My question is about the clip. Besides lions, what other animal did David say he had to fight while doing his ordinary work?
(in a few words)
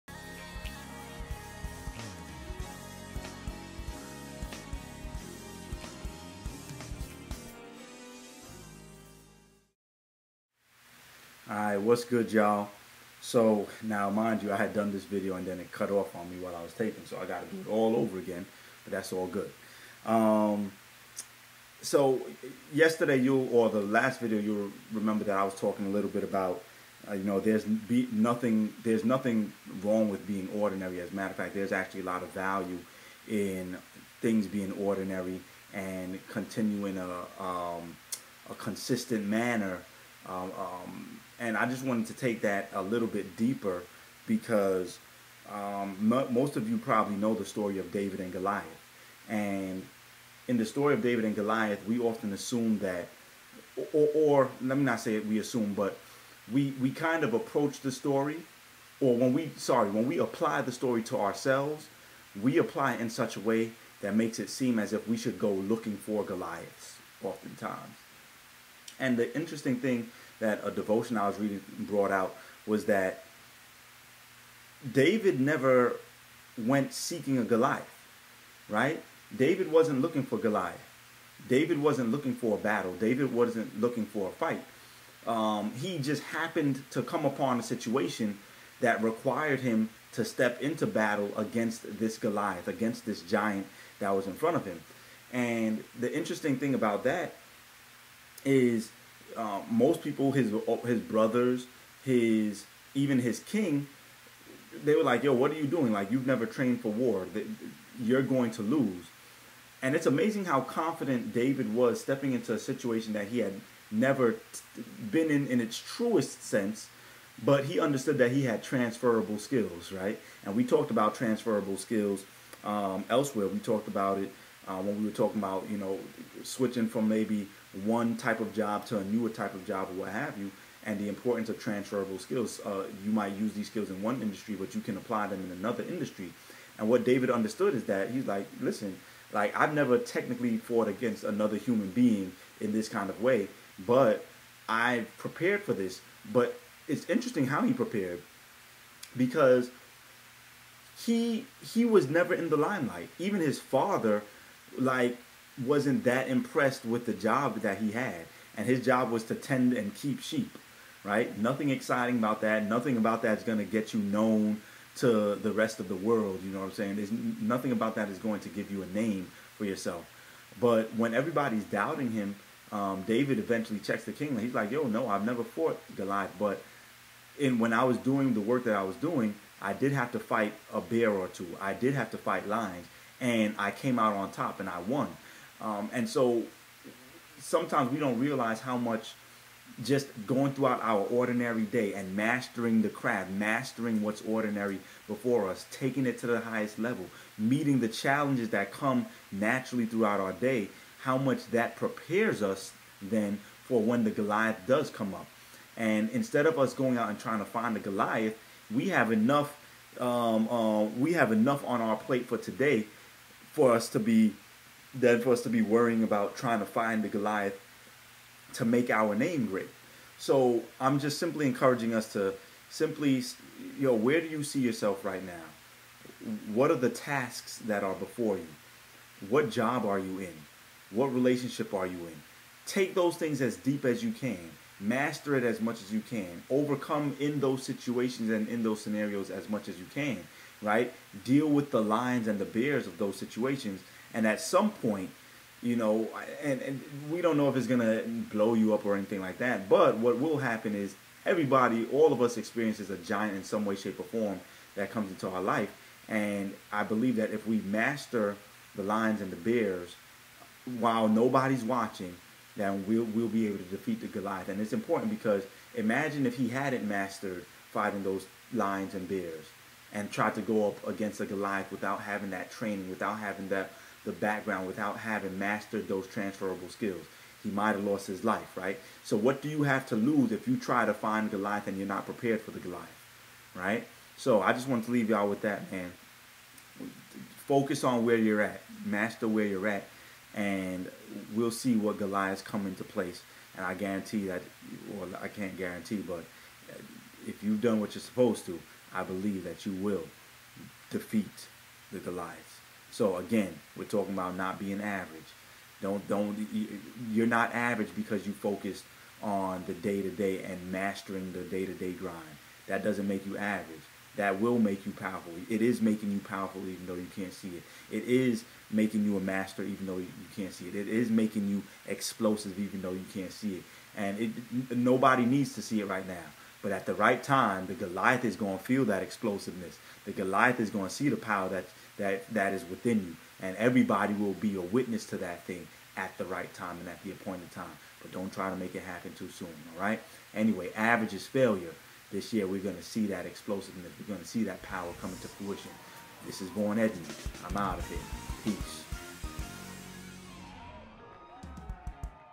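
a bear.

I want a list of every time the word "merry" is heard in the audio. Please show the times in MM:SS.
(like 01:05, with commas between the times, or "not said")
not said.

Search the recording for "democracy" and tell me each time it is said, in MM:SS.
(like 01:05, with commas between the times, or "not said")
not said.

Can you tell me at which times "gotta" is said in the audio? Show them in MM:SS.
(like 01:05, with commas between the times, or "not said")
00:17.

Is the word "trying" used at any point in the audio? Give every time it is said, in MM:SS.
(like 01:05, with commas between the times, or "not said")
03:27, 03:36.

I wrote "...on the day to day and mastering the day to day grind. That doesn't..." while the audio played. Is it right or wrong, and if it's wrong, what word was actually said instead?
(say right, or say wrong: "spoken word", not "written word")
right.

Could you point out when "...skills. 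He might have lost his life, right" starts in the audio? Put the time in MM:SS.
04:36.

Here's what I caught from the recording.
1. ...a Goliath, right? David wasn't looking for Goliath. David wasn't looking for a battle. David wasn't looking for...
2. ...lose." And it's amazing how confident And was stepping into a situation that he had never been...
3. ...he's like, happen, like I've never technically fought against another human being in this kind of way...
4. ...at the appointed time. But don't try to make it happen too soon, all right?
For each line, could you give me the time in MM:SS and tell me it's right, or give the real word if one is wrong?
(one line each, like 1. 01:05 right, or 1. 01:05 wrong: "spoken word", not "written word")
1. 01:17 right
2. 01:48 wrong: "David", not "And"
3. 02:18 wrong: "listen", not "happen"
4. 05:36 right.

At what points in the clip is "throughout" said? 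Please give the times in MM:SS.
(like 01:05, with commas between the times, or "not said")
03:10, 03:19.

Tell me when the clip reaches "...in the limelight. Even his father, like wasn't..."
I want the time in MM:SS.
02:32.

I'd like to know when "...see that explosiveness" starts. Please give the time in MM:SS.
05:42.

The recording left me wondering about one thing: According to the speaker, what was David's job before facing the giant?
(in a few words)
tend and keep sheep.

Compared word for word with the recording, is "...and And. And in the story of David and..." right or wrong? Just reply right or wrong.
wrong.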